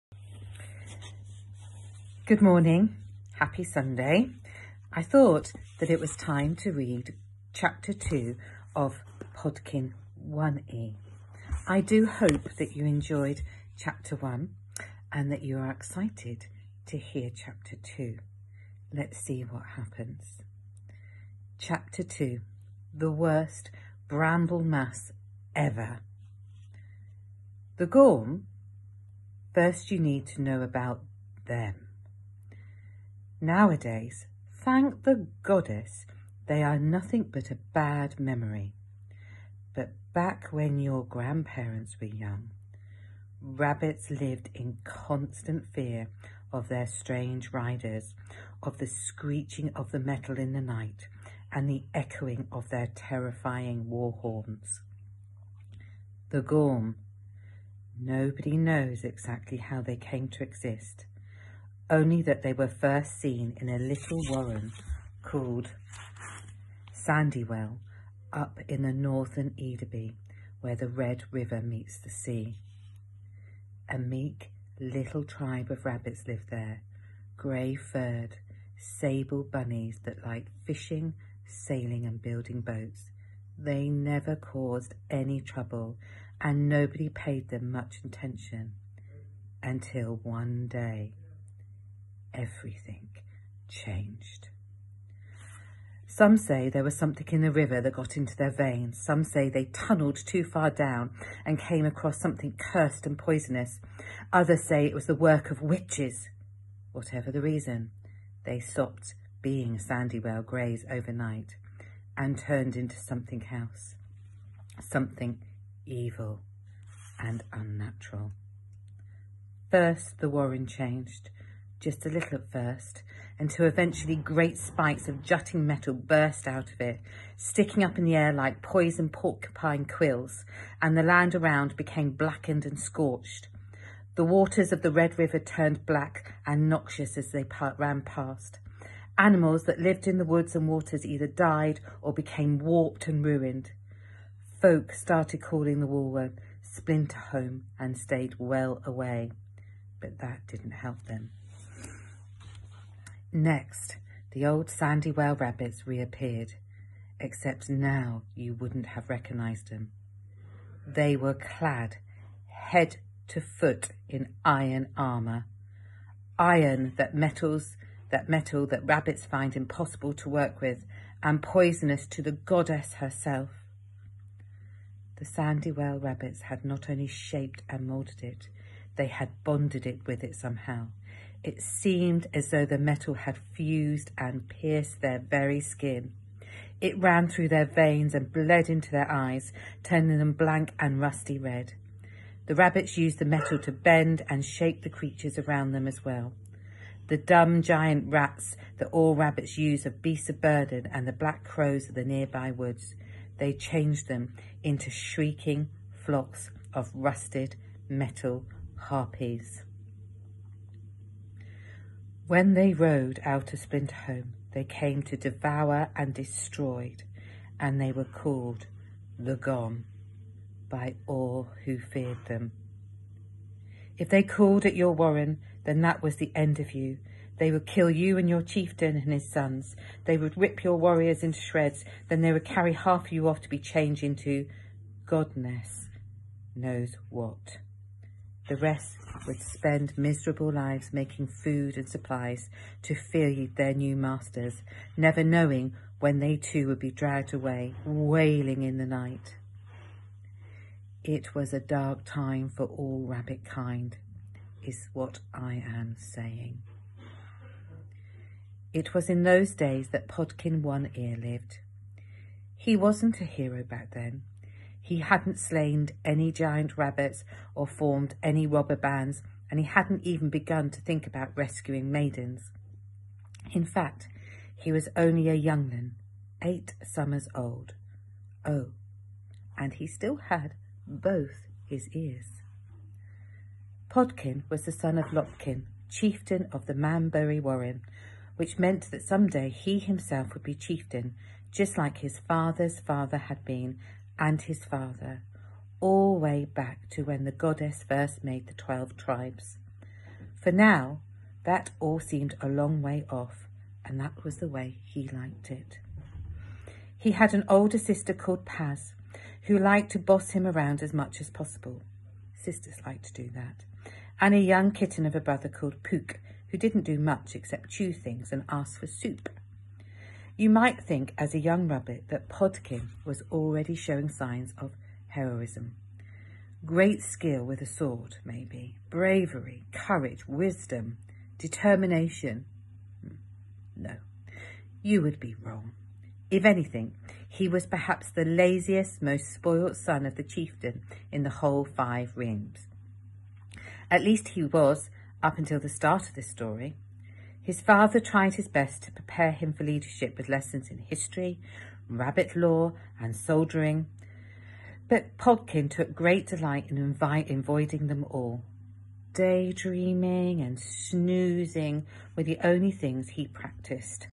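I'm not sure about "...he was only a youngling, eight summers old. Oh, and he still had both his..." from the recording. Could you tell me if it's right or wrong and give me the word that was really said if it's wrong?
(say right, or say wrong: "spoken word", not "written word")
right.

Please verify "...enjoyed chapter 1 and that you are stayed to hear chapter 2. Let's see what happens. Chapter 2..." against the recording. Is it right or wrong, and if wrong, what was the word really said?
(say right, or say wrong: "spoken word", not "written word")
wrong: "excited", not "stayed".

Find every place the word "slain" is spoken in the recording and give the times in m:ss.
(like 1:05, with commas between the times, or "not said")
4:25.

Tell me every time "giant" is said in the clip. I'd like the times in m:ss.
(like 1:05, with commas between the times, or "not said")
3:17, 4:26.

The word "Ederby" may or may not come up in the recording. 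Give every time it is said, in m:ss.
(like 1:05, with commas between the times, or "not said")
1:09.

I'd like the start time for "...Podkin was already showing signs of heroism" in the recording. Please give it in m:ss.
5:22.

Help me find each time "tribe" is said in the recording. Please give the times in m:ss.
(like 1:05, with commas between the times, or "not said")
1:15, 4:58.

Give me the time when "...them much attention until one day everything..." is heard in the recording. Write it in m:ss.
1:27.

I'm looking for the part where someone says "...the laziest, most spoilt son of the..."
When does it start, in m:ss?
5:38.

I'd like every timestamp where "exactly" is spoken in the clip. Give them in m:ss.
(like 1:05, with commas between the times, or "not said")
0:59.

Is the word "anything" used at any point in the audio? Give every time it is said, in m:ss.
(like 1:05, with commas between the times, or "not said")
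5:36.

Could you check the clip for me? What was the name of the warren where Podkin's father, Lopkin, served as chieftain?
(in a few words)
Manbury Warren.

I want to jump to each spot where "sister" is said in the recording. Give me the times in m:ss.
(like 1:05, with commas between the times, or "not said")
5:07, 5:12.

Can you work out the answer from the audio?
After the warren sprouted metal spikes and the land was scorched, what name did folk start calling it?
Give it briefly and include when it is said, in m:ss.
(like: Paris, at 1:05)
Splinter Home, at 2:26.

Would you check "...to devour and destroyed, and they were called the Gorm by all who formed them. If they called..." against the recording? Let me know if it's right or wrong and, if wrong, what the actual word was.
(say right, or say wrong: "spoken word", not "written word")
wrong: "feared", not "formed".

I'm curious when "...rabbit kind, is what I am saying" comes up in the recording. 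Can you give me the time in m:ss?
4:13.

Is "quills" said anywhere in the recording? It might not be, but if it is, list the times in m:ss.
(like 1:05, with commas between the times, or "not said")
2:09.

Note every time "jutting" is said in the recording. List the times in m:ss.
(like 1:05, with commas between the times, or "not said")
2:05.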